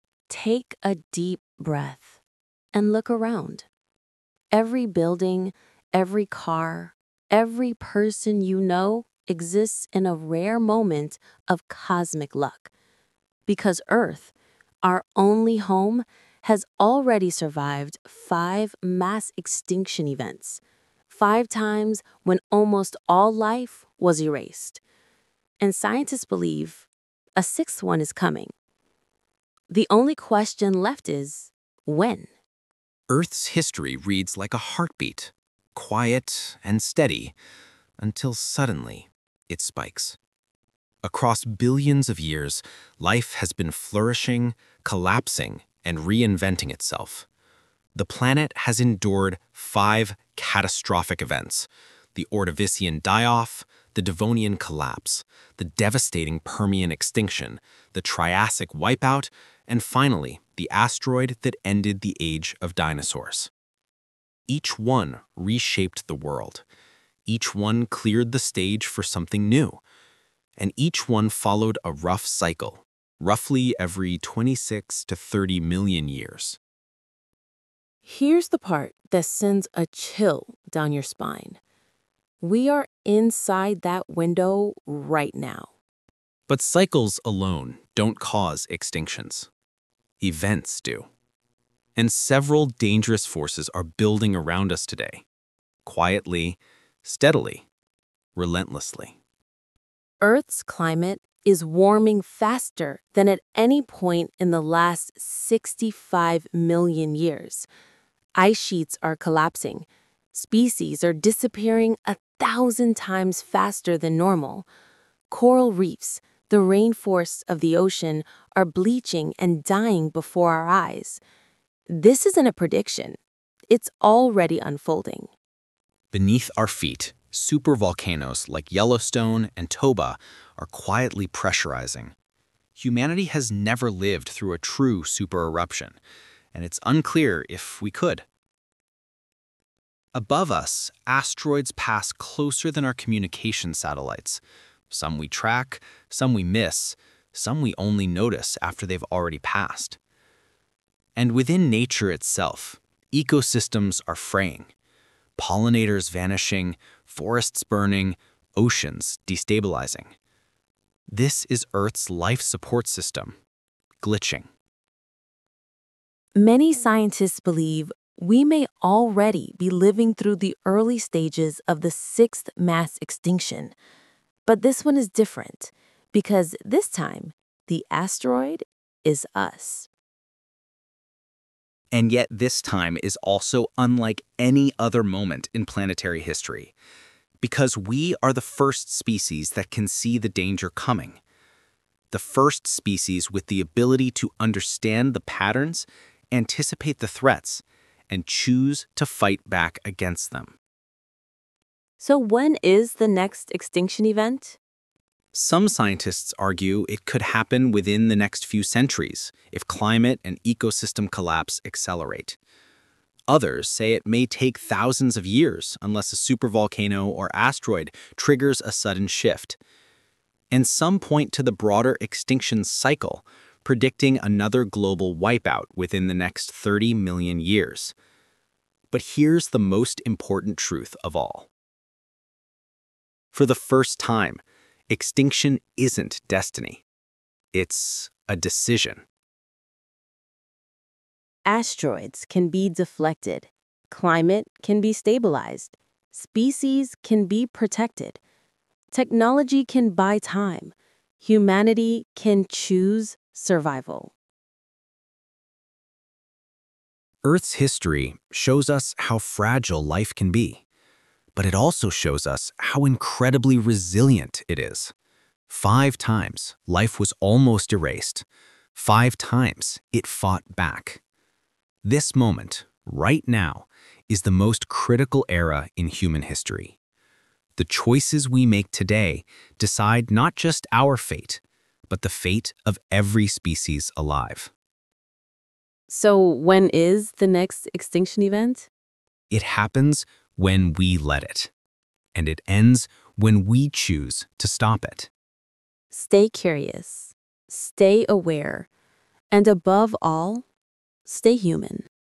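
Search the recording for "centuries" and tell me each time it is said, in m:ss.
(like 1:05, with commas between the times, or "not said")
3:28.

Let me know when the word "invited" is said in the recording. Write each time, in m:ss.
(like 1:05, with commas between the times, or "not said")
not said.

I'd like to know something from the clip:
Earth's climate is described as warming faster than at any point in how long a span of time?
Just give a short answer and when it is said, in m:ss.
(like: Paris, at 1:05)
the last 65 million years, at 1:45.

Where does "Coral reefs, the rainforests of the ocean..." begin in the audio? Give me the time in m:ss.
1:55.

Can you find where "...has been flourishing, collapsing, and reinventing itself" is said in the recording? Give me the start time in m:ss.
0:43.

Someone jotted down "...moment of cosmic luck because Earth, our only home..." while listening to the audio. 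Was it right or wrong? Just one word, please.
right.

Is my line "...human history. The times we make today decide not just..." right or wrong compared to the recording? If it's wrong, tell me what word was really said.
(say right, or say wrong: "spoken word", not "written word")
wrong: "choices", not "times".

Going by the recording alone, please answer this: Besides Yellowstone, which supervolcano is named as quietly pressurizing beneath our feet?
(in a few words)
Toba.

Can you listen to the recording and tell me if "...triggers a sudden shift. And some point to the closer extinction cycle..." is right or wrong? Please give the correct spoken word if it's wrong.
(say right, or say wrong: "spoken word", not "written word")
wrong: "broader", not "closer".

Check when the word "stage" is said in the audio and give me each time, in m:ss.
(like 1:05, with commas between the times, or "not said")
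1:08, 2:50.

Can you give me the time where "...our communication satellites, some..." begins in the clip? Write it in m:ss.
2:22.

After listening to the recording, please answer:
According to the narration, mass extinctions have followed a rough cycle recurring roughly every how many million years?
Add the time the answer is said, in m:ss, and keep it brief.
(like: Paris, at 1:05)
26 to 30 million years, at 1:14.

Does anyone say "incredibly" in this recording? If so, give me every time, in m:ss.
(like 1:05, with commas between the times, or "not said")
4:22.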